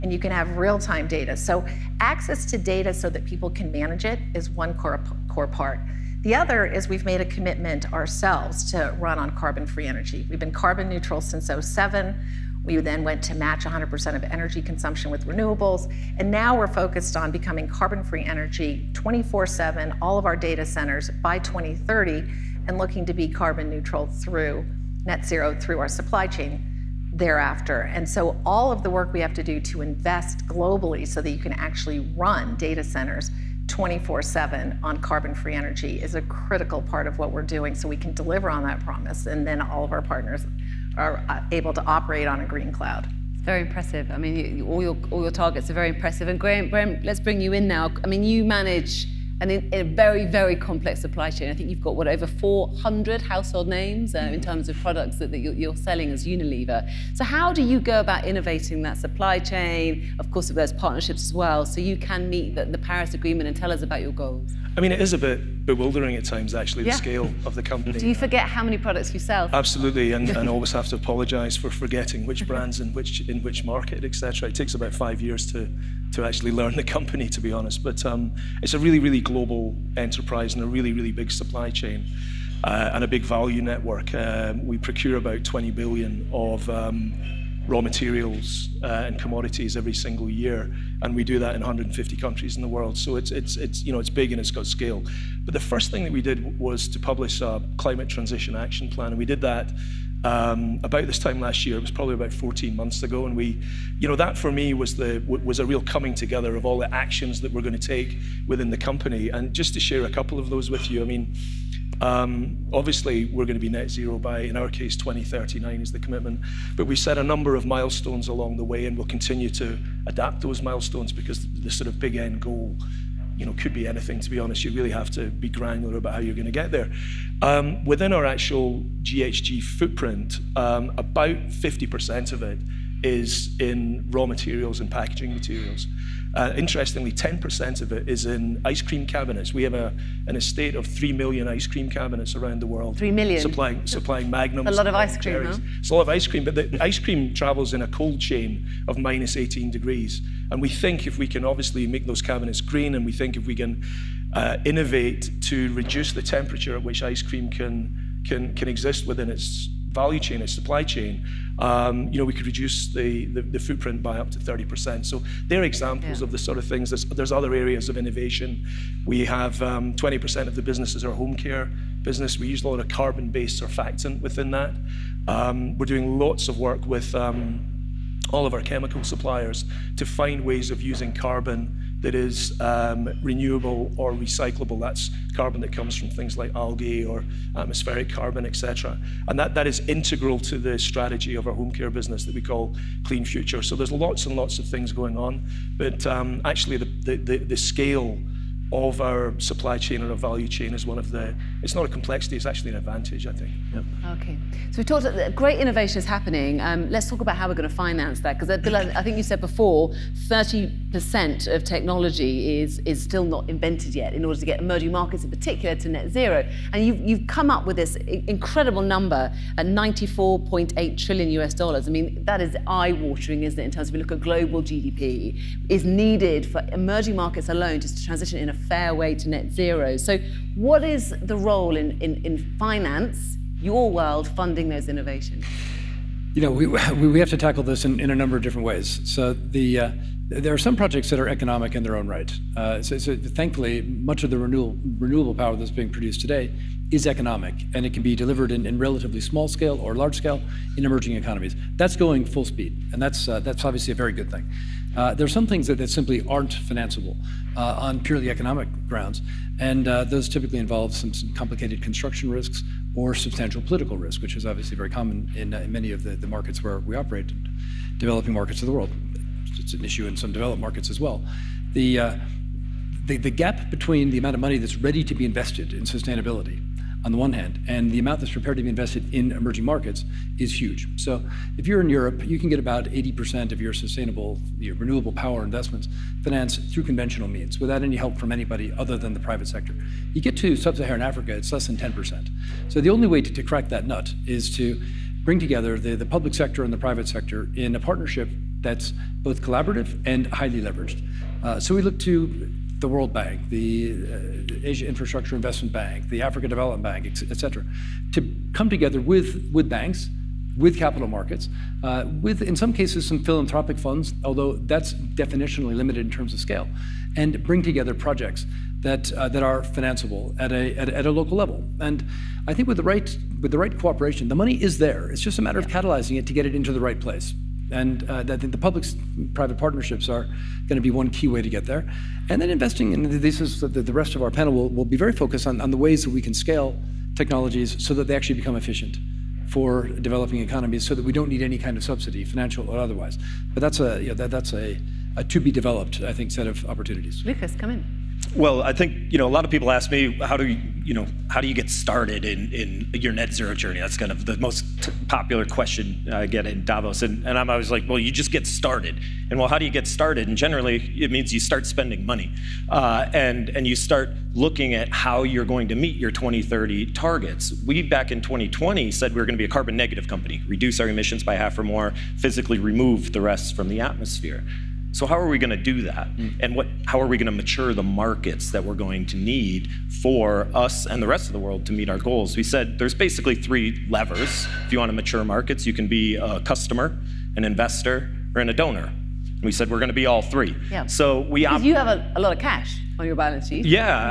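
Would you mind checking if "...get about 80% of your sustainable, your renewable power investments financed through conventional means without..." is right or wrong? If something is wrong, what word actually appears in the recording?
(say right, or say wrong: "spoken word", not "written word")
right.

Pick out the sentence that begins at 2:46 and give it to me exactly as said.
There's, there's other areas of innovation.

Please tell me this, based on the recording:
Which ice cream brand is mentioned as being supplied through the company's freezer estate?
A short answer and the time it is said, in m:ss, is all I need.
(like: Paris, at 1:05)
Magnum, at 2:24.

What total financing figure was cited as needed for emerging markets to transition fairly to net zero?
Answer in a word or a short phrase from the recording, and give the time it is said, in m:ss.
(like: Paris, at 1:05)
94.8 trillion US dollars, at 3:39.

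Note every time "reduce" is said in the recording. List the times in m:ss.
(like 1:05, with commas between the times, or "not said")
2:35, 2:42, 6:10.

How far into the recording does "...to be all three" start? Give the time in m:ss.
6:29.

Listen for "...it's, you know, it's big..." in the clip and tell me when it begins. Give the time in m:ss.
1:33.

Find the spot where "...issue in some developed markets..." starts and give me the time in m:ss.
4:29.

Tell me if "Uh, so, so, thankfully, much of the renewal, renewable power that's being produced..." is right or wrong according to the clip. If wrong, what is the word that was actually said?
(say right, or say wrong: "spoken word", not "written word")
right.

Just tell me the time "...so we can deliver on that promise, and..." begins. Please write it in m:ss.
0:37.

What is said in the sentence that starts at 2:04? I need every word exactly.
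You really have to be granular about how you're going to get there.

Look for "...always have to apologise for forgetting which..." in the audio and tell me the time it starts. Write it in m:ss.
1:10.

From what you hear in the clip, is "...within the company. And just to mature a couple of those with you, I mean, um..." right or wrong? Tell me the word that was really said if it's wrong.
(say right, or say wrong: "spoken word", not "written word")
wrong: "share", not "mature".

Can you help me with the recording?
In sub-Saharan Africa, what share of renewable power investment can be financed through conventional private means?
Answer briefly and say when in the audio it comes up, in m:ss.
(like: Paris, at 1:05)
less than 10%, at 4:51.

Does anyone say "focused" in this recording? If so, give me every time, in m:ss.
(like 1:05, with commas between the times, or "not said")
0:16, 5:35.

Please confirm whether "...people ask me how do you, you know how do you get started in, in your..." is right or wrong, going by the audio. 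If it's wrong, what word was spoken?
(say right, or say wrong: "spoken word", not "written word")
right.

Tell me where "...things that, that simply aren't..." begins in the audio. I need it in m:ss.
4:15.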